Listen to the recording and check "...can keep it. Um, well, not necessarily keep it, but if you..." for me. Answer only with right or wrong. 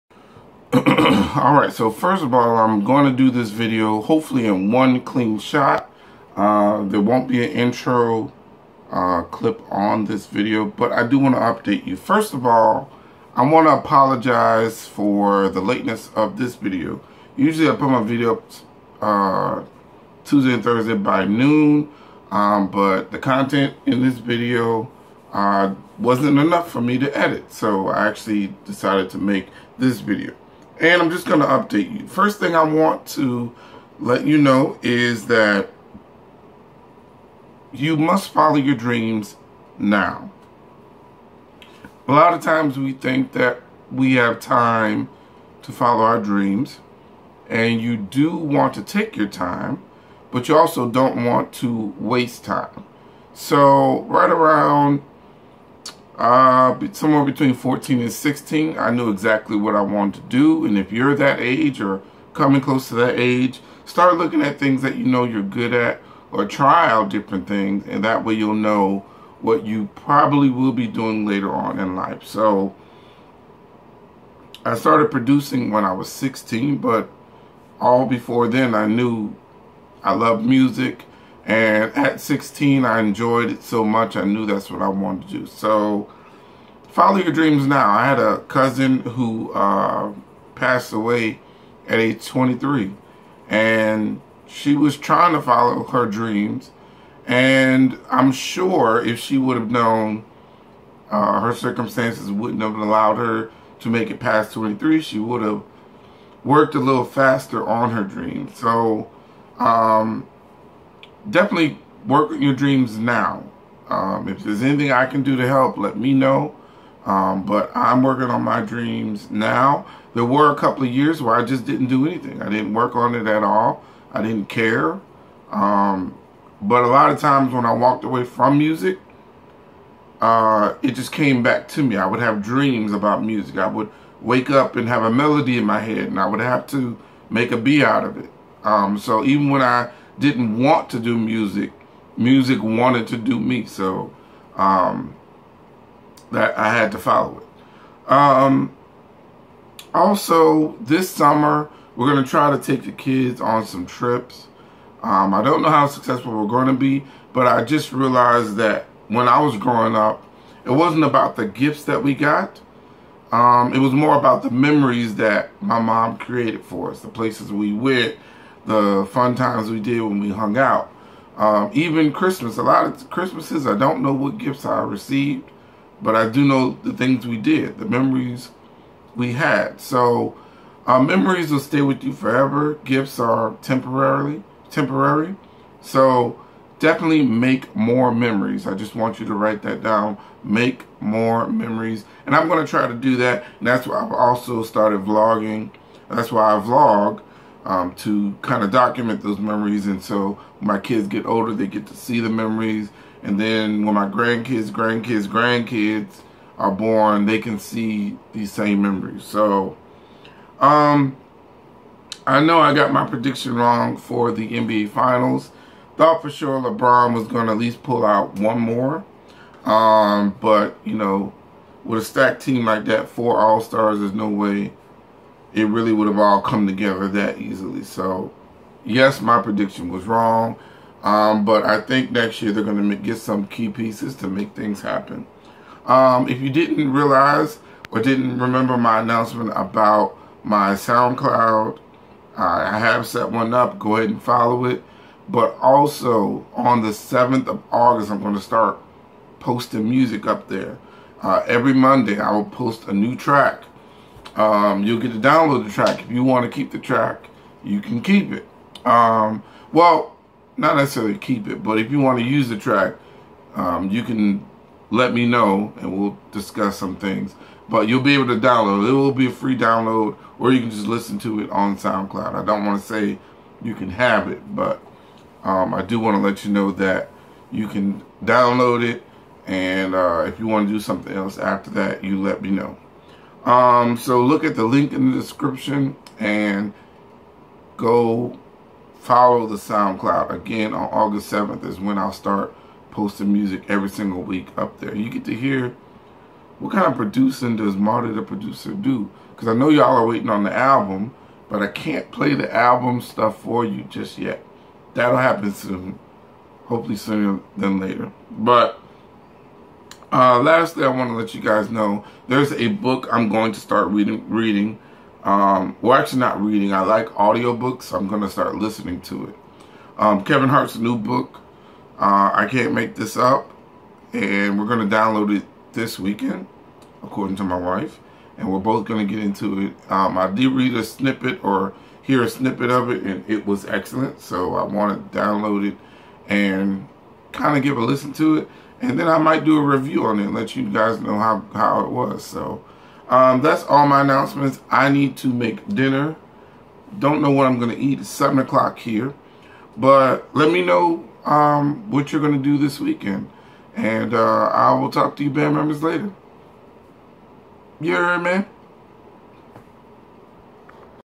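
right.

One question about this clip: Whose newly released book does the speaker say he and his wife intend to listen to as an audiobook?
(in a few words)
Kevin Hart.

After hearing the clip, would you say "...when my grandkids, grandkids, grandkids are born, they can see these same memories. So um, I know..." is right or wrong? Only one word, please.
right.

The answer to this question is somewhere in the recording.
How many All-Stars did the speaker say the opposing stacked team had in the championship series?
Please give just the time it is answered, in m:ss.
3:43.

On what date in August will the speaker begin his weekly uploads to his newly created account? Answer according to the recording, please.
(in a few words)
August 7th.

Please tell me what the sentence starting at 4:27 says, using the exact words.
But you'll be able to download.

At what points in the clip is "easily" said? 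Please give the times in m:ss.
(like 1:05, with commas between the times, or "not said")
3:47.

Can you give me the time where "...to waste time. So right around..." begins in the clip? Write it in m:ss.
0:51.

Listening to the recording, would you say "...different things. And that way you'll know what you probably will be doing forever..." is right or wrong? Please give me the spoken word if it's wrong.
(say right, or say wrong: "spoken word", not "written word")
wrong: "later", not "forever".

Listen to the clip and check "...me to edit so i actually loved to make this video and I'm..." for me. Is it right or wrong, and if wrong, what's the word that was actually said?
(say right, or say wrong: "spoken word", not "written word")
wrong: "decided", not "loved".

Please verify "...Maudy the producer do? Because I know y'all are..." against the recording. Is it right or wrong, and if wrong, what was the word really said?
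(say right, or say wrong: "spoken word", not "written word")
right.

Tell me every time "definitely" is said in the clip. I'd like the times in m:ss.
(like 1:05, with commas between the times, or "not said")
1:51, 3:06.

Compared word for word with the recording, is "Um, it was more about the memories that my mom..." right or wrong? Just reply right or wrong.
right.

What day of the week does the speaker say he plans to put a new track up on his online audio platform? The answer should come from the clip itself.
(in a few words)
Monday.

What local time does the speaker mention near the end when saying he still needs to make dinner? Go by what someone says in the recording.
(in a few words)
7 o'clock.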